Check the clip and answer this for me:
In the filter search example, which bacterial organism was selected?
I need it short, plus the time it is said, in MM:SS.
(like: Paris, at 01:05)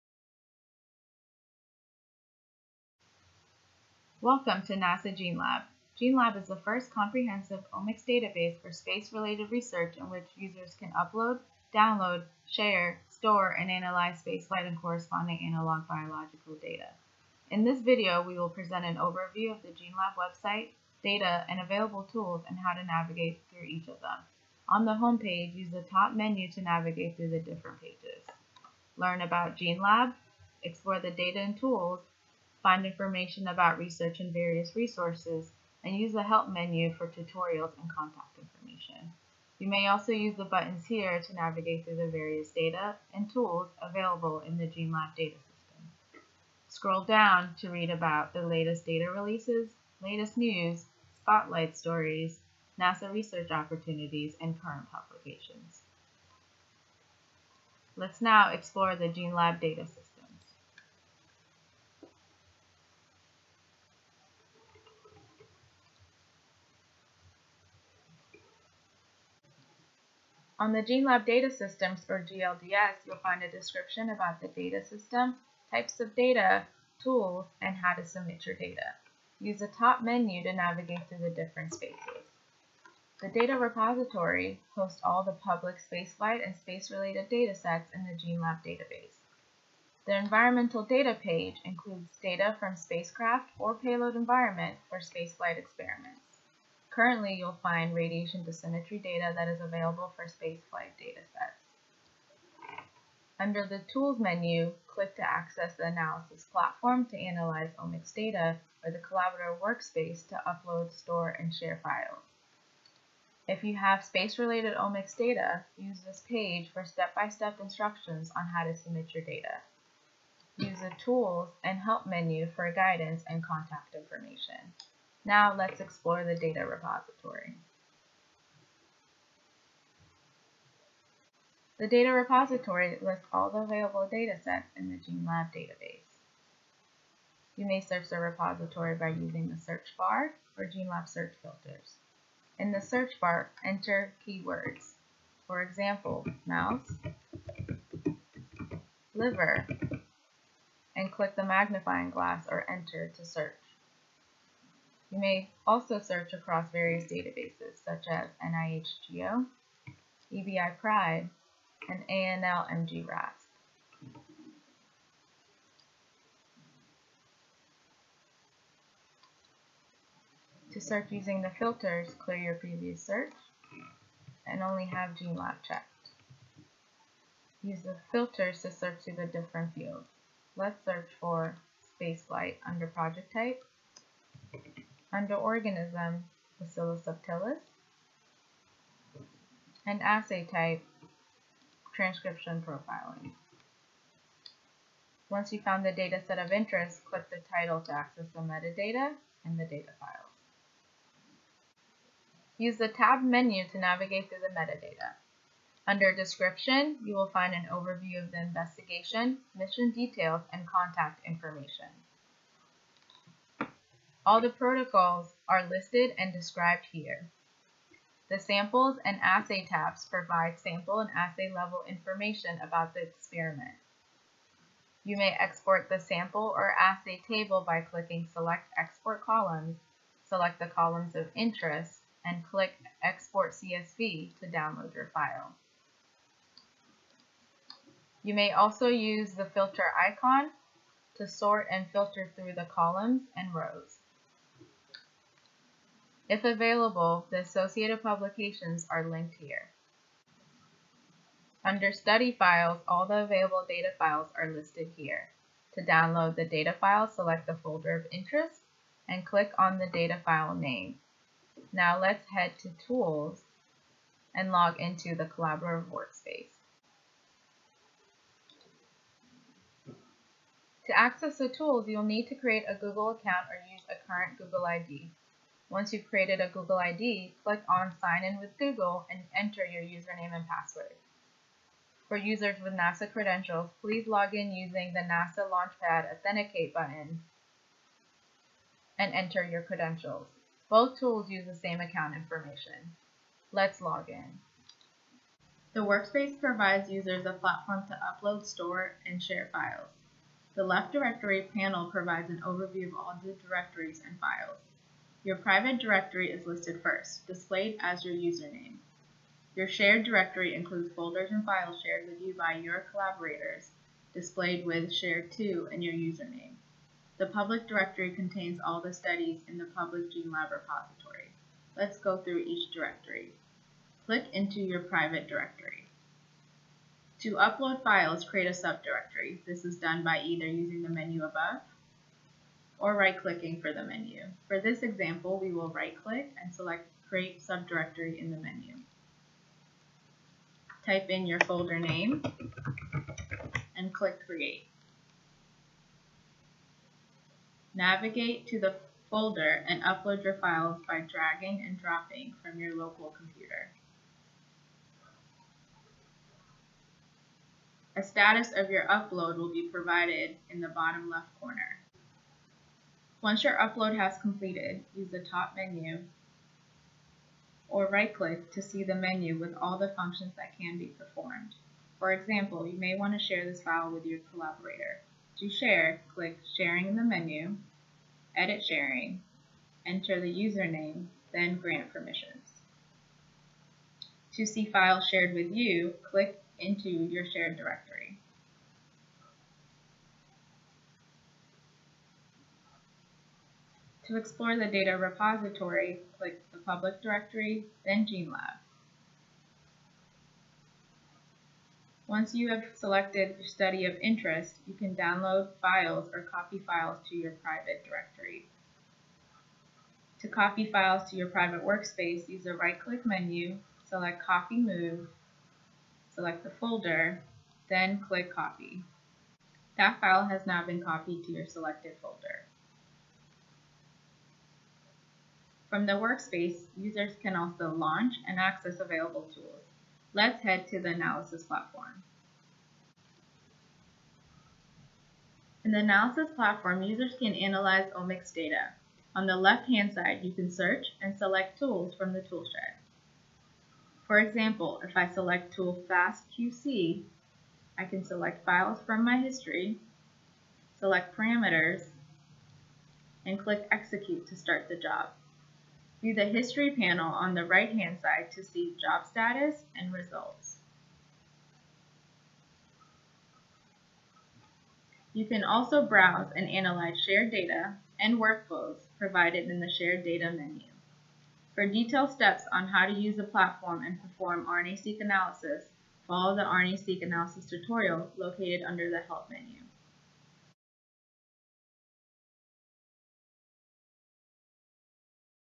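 Bacillus subtilis, at 03:06.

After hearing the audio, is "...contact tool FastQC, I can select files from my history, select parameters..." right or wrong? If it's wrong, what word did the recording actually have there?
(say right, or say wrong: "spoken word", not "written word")
wrong: "select", not "contact".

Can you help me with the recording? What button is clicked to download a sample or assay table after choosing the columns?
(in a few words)
Export CSV.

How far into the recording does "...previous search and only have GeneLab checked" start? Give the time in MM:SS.
02:52.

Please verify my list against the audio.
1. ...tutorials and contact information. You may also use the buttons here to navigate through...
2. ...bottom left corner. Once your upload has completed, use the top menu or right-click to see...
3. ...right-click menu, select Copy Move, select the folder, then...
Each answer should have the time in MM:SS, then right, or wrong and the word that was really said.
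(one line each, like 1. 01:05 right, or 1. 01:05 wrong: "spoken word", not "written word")
1. 00:37 right
2. 06:00 right
3. 06:52 right.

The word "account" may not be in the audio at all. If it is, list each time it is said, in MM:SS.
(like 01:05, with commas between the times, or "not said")
04:33, 04:51.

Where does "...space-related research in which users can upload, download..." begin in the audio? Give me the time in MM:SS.
00:08.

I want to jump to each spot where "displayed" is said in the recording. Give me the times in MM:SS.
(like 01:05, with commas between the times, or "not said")
05:07, 05:14.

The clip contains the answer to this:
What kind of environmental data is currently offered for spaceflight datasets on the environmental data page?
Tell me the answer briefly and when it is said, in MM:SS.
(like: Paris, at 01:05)
Radiation dosimetry data, at 01:37.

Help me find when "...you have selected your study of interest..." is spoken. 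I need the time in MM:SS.
06:42.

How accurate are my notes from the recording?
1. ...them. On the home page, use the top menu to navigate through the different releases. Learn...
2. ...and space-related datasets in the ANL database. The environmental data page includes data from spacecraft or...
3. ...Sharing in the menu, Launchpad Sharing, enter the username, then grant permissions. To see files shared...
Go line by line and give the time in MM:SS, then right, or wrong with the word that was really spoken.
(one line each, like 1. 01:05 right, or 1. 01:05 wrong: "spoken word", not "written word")
1. 00:24 wrong: "pages", not "releases"
2. 01:26 wrong: "GeneLab", not "ANL"
3. 06:16 wrong: "Edit", not "Launchpad".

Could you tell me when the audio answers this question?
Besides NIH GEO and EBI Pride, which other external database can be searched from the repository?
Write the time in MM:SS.
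02:42.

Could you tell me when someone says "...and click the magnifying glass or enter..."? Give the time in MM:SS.
02:30.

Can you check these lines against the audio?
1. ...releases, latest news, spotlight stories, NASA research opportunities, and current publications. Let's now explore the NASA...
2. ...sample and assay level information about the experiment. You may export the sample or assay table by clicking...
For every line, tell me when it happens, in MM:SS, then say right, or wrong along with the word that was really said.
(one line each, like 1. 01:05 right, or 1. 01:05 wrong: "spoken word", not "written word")
1. 00:49 wrong: "GeneLab", not "NASA"
2. 03:40 right.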